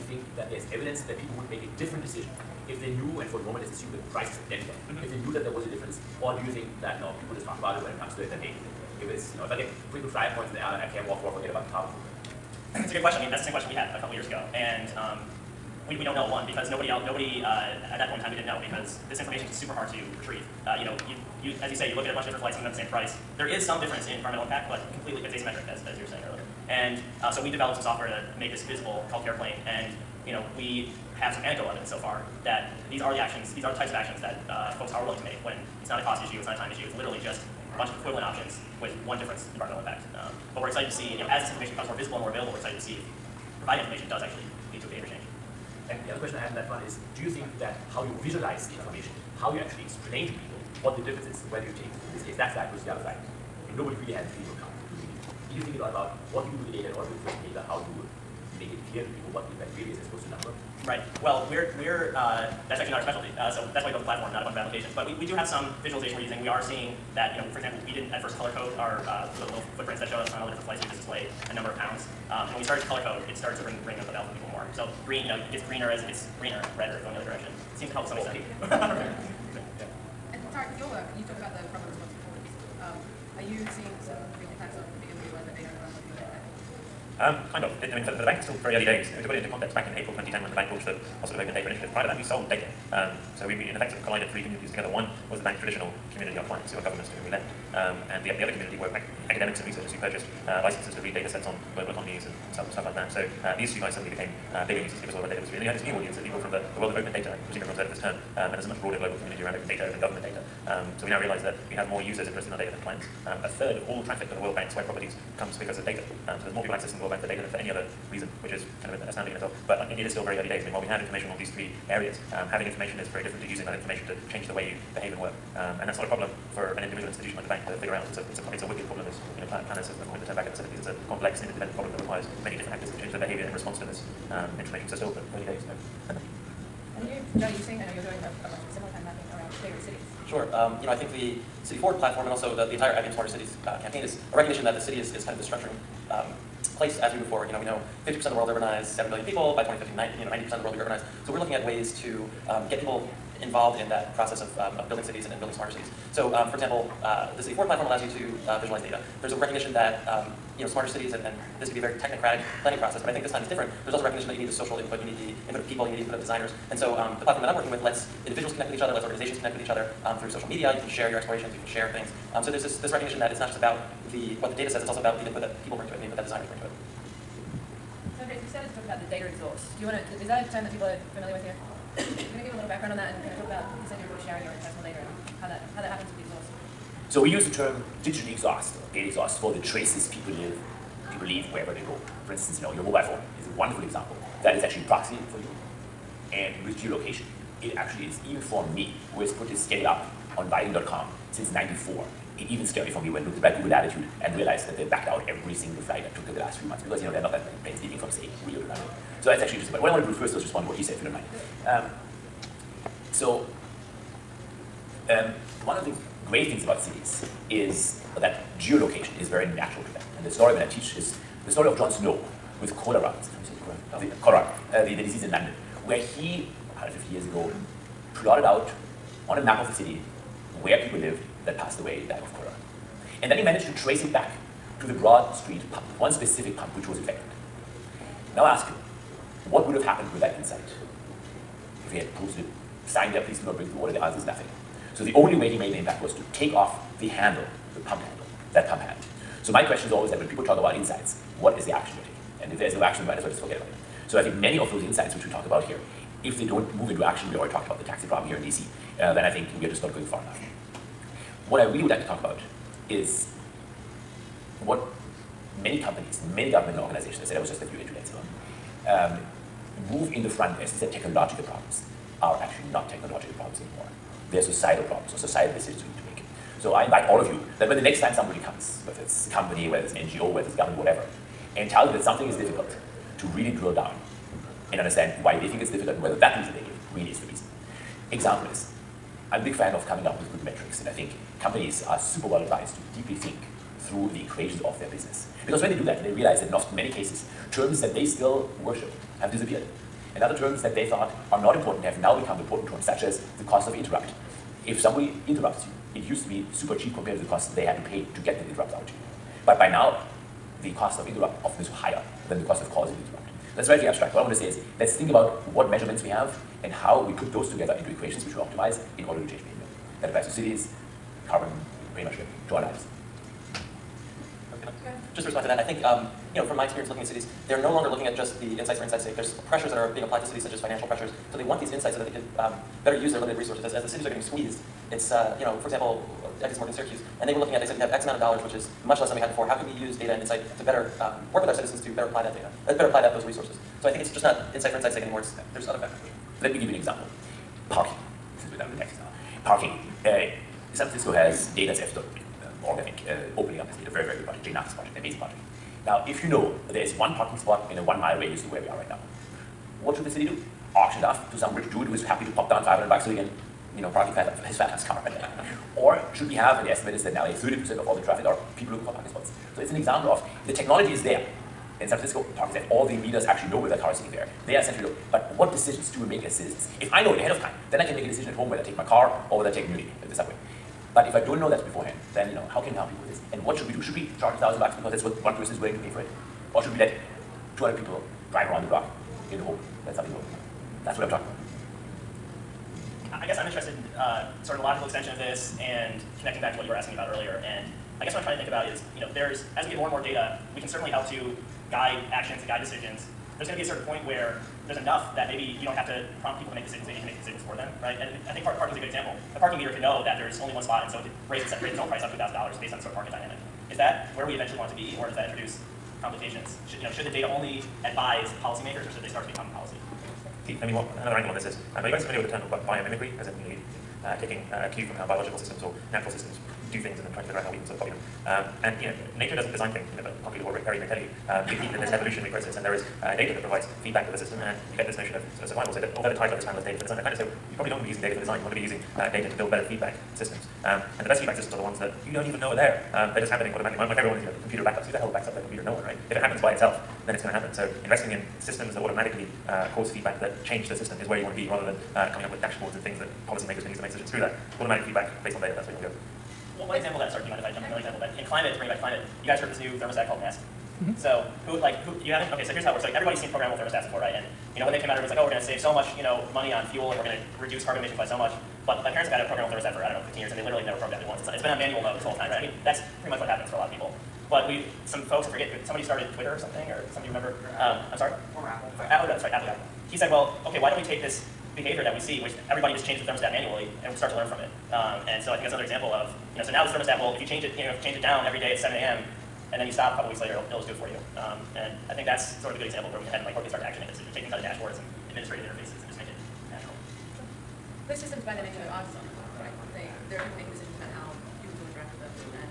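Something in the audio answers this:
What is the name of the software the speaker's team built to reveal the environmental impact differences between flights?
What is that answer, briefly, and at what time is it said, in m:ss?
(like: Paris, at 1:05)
CarePlane, at 0:29.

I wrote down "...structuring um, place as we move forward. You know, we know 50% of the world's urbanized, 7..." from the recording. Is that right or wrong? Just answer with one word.
right.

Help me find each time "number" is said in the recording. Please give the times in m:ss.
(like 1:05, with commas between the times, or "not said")
1:00, 1:11.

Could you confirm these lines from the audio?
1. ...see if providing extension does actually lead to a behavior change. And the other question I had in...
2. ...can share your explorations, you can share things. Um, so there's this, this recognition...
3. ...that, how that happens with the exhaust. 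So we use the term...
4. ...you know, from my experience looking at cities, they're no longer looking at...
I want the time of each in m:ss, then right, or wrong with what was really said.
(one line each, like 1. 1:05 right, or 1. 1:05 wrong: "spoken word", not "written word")
1. 0:42 wrong: "information", not "extension"
2. 2:50 right
3. 3:05 right
4. 5:26 right.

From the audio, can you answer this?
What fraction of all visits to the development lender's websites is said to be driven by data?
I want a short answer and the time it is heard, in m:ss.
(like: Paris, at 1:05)
A third, at 1:53.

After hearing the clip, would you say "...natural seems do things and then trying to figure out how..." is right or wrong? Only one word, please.
wrong.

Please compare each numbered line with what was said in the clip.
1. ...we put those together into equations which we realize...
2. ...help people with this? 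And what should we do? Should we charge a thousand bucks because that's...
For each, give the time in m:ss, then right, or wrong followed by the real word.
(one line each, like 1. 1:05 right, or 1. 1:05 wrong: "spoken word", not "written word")
1. 5:17 wrong: "optimize", not "realize"
2. 6:22 right.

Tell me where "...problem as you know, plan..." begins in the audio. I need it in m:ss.
2:08.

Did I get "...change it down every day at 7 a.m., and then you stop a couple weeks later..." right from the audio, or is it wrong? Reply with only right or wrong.
right.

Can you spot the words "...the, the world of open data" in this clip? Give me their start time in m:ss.
1:46.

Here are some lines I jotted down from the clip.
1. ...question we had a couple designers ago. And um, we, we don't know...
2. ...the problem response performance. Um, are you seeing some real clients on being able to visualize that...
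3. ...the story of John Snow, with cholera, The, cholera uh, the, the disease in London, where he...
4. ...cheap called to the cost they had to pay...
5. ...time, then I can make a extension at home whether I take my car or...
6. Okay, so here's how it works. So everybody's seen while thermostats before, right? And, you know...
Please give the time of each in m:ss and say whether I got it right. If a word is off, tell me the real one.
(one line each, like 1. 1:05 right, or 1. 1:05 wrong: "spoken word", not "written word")
1. 0:13 wrong: "years", not "designers"
2. 1:21 wrong: "impacts", not "clients"
3. 3:41 right
4. 5:06 wrong: "compared", not "called"
5. 6:17 wrong: "decision", not "extension"
6. 7:42 wrong: "programmable", not "while".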